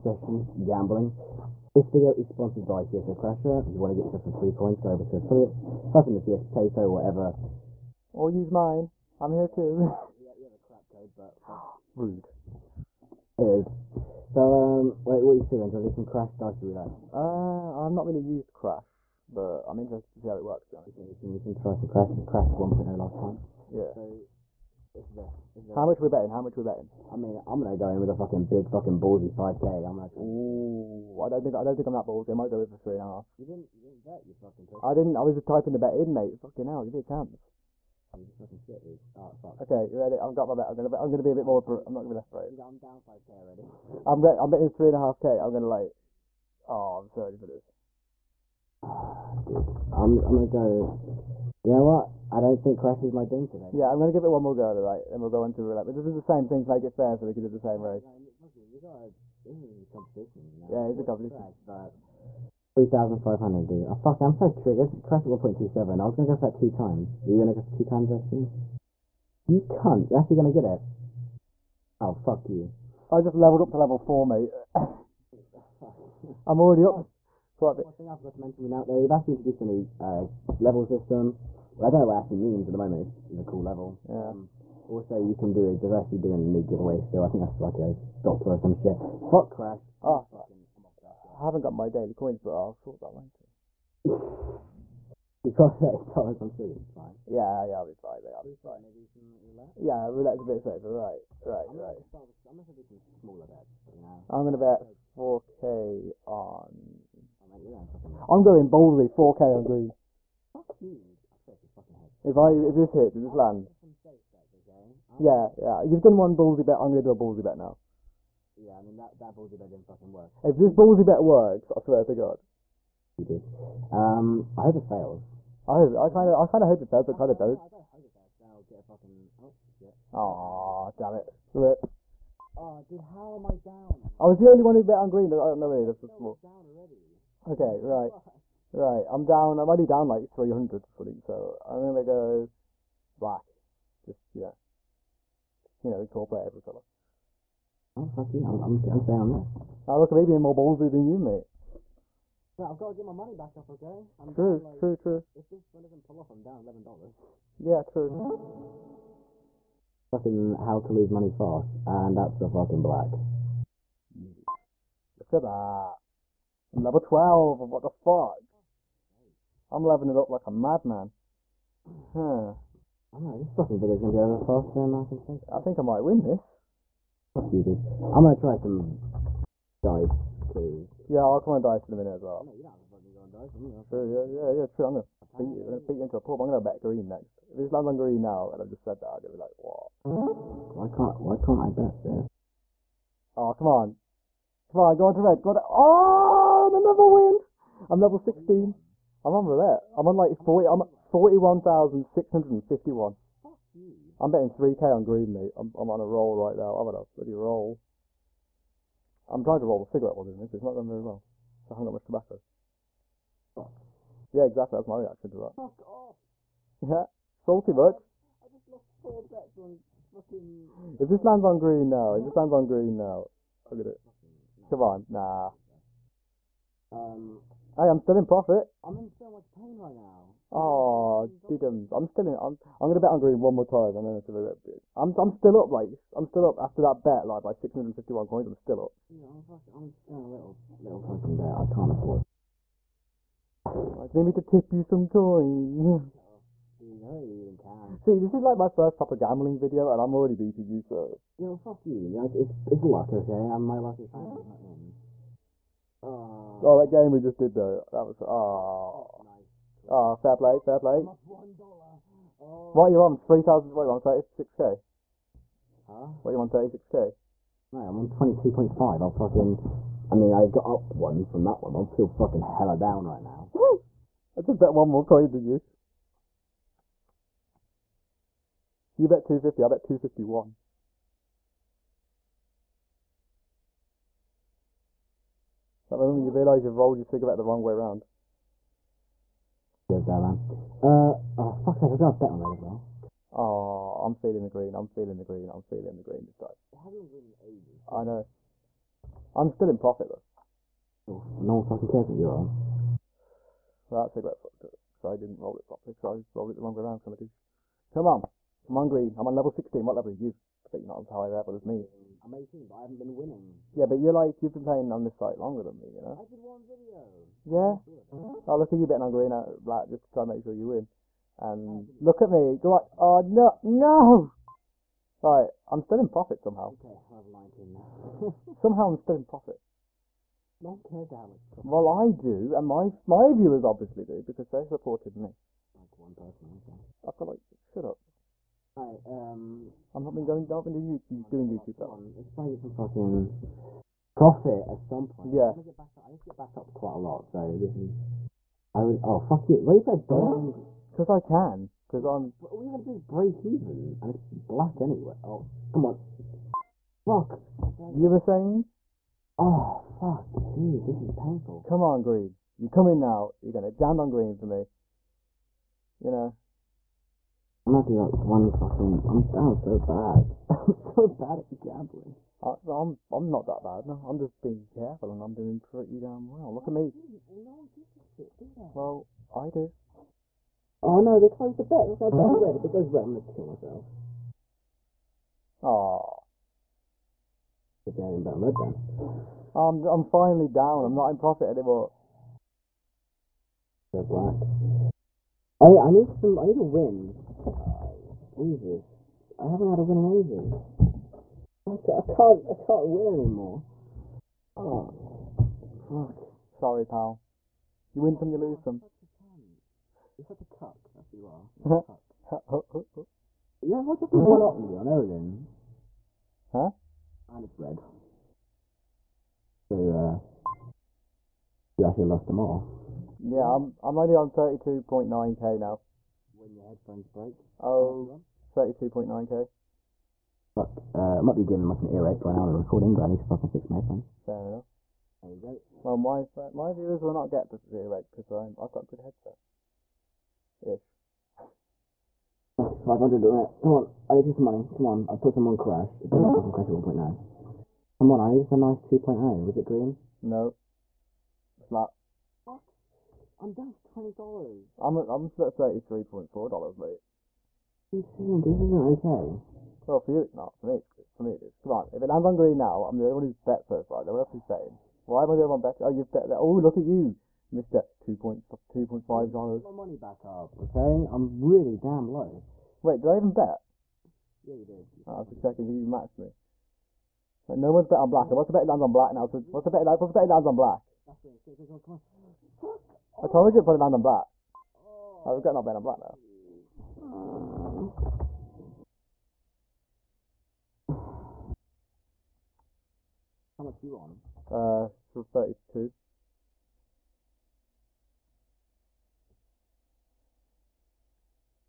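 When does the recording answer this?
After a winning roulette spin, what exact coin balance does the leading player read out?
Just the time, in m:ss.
3:20.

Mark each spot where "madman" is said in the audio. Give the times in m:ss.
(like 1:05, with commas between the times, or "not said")
2:50.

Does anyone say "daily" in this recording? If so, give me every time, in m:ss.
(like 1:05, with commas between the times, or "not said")
1:31.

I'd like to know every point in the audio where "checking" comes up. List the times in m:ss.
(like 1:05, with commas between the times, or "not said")
7:55.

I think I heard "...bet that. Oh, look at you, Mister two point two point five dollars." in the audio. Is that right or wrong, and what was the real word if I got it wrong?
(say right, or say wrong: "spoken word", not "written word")
right.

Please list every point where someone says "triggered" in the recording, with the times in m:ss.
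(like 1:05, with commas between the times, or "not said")
1:04.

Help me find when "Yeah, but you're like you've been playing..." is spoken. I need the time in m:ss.
5:13.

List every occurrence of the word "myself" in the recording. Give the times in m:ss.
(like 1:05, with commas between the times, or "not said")
6:23, 7:11.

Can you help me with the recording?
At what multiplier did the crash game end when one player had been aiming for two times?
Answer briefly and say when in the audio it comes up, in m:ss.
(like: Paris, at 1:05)
1.27, at 1:05.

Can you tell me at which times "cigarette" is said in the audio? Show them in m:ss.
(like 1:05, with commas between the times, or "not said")
3:29, 4:47, 5:04.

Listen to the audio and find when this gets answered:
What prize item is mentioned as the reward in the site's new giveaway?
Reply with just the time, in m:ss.
1:27.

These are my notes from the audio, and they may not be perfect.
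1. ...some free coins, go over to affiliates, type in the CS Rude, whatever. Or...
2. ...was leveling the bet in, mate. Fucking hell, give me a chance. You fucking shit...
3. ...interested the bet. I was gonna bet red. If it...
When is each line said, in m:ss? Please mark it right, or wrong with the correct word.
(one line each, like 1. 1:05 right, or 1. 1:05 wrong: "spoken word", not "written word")
1. 0:04 wrong: "Potato", not "Rude"
2. 0:35 wrong: "typing", not "leveling"
3. 6:21 wrong: "closed", not "interested".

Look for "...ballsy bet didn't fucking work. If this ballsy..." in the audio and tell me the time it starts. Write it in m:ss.
1:59.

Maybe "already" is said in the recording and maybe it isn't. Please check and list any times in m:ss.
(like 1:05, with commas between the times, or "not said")
0:43, 1:16, 2:16, 4:10.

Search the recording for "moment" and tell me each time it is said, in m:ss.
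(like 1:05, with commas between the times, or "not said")
1:22, 4:45.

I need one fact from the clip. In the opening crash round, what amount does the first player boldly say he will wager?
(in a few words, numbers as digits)
5k.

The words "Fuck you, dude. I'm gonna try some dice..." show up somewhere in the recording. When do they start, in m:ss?
2:57.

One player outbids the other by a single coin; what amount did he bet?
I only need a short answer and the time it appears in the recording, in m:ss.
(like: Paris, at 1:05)
251, at 4:39.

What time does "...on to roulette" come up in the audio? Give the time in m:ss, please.
0:55.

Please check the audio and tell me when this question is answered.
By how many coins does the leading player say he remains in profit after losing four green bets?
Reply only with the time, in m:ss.
3:57.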